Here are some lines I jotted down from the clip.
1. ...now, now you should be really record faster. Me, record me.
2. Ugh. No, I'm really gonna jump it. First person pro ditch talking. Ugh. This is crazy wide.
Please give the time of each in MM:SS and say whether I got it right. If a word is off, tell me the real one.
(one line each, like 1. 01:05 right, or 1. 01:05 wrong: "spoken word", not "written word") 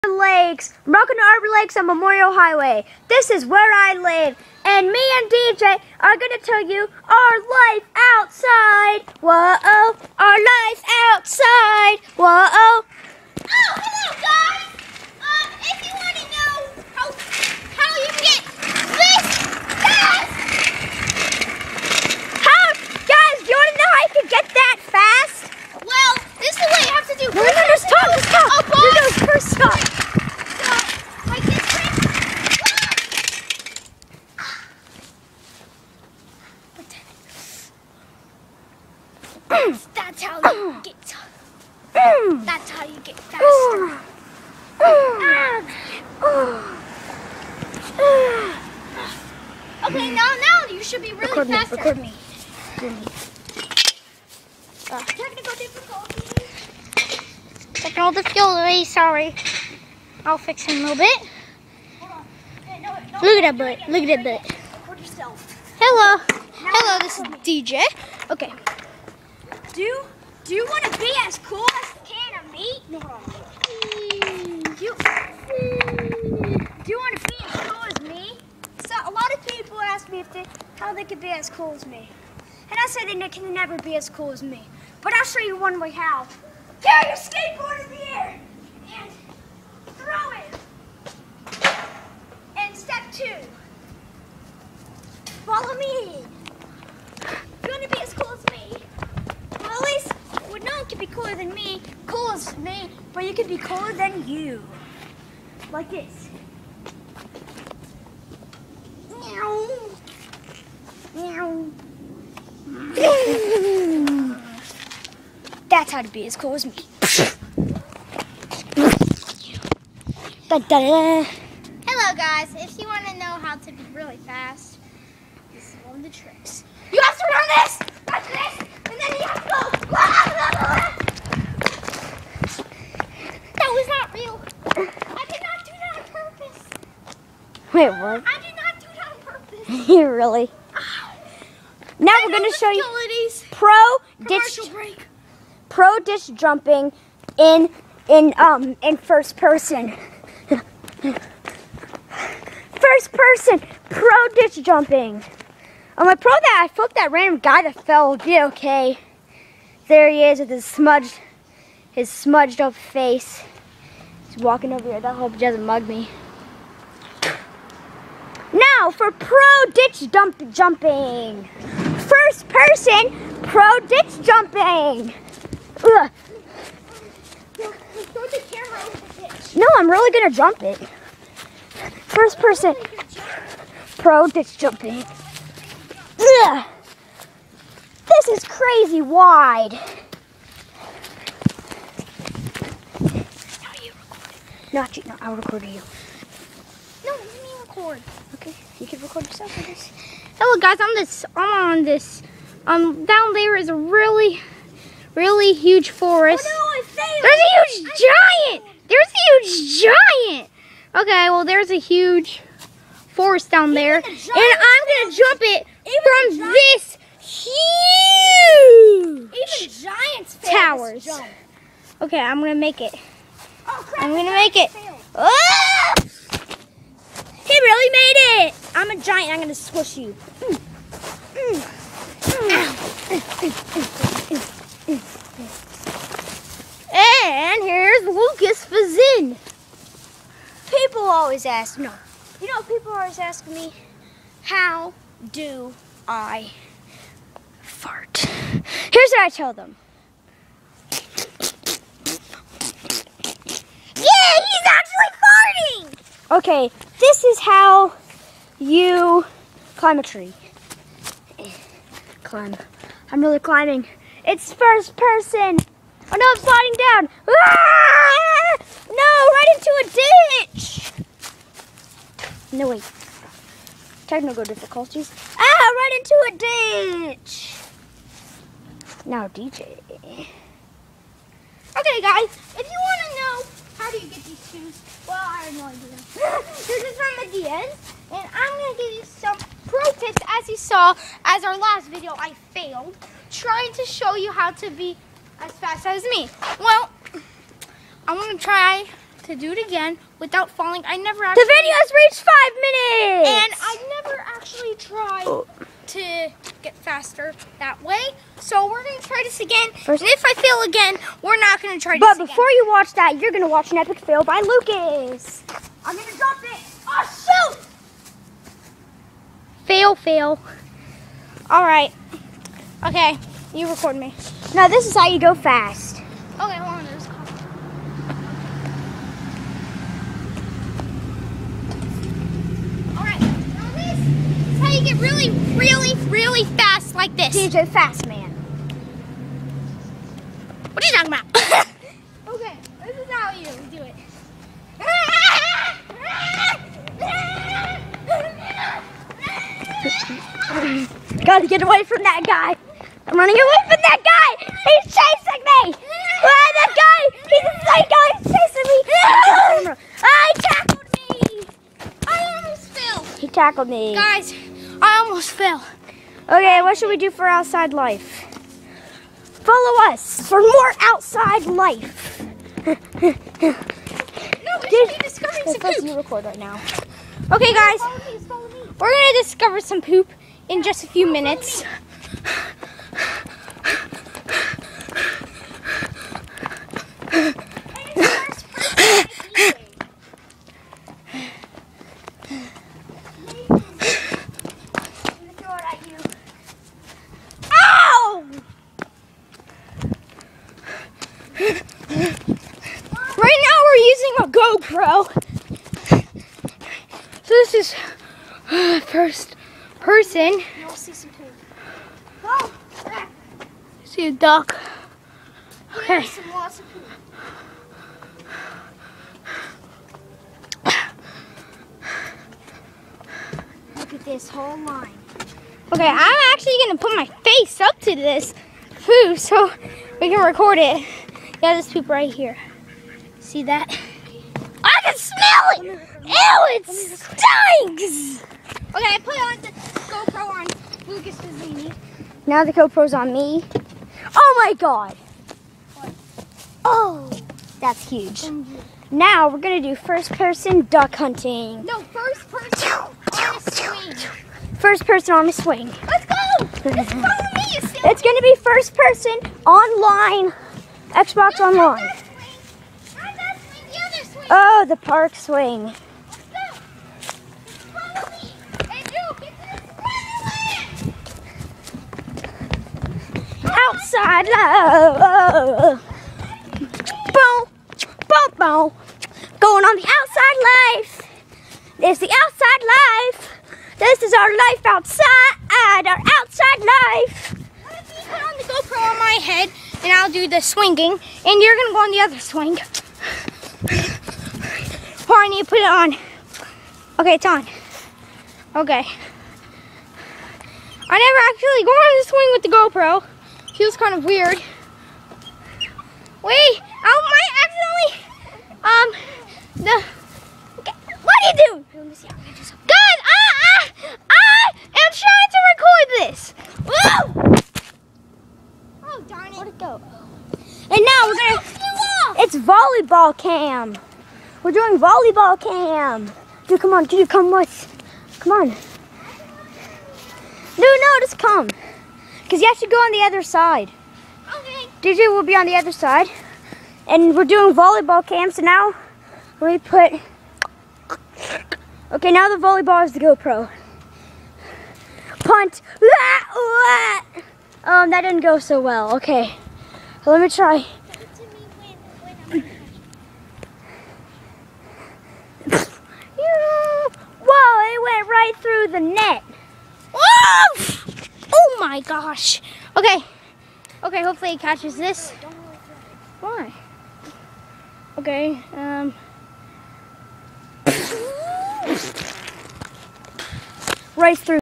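1. 00:50 right
2. 02:55 wrong: "jumping", not "talking".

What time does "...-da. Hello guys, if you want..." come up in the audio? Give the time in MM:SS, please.
02:00.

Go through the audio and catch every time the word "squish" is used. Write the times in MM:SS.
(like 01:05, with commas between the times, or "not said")
03:49.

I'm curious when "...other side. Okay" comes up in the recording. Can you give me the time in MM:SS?
08:53.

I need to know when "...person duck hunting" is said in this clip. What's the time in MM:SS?
07:30.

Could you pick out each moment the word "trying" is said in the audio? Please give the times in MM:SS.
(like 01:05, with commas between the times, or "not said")
04:53, 08:35.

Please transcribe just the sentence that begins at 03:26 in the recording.
Oh, no, there's a huge I giant!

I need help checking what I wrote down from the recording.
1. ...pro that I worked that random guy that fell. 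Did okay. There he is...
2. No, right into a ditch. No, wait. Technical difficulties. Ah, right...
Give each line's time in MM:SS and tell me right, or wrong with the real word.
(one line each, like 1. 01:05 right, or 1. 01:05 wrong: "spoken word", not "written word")
1. 02:36 wrong: "flipped", not "worked"
2. 04:28 right.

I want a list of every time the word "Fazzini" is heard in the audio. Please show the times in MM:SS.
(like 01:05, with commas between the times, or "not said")
03:58, 07:21.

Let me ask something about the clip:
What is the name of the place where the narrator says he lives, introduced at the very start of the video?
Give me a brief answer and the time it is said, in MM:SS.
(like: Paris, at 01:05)
Arbor Lakes, at 00:00.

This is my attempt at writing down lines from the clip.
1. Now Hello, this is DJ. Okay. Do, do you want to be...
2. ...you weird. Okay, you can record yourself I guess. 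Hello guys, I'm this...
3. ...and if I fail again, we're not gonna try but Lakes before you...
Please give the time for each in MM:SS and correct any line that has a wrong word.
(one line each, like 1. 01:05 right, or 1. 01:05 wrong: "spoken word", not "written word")
1. 01:06 right
2. 03:15 wrong: "record", not "weird"
3. 05:10 wrong: "But", not "Lakes".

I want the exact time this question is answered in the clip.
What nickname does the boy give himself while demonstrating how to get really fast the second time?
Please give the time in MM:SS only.
05:37.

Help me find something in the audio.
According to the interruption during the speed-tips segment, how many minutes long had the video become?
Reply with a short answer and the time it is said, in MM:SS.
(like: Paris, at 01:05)
5, at 05:03.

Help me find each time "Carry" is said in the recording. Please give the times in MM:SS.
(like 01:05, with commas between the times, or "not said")
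01:26.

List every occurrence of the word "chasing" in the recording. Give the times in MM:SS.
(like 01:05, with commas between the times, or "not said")
05:54, 05:59.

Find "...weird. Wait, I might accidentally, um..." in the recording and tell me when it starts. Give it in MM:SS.
08:24.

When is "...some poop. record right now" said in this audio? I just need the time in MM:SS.
06:15.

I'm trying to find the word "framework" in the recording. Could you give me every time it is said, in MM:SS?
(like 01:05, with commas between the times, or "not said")
not said.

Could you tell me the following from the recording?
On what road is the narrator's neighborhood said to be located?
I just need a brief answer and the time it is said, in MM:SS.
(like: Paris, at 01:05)
Memorial Highway, at 00:01.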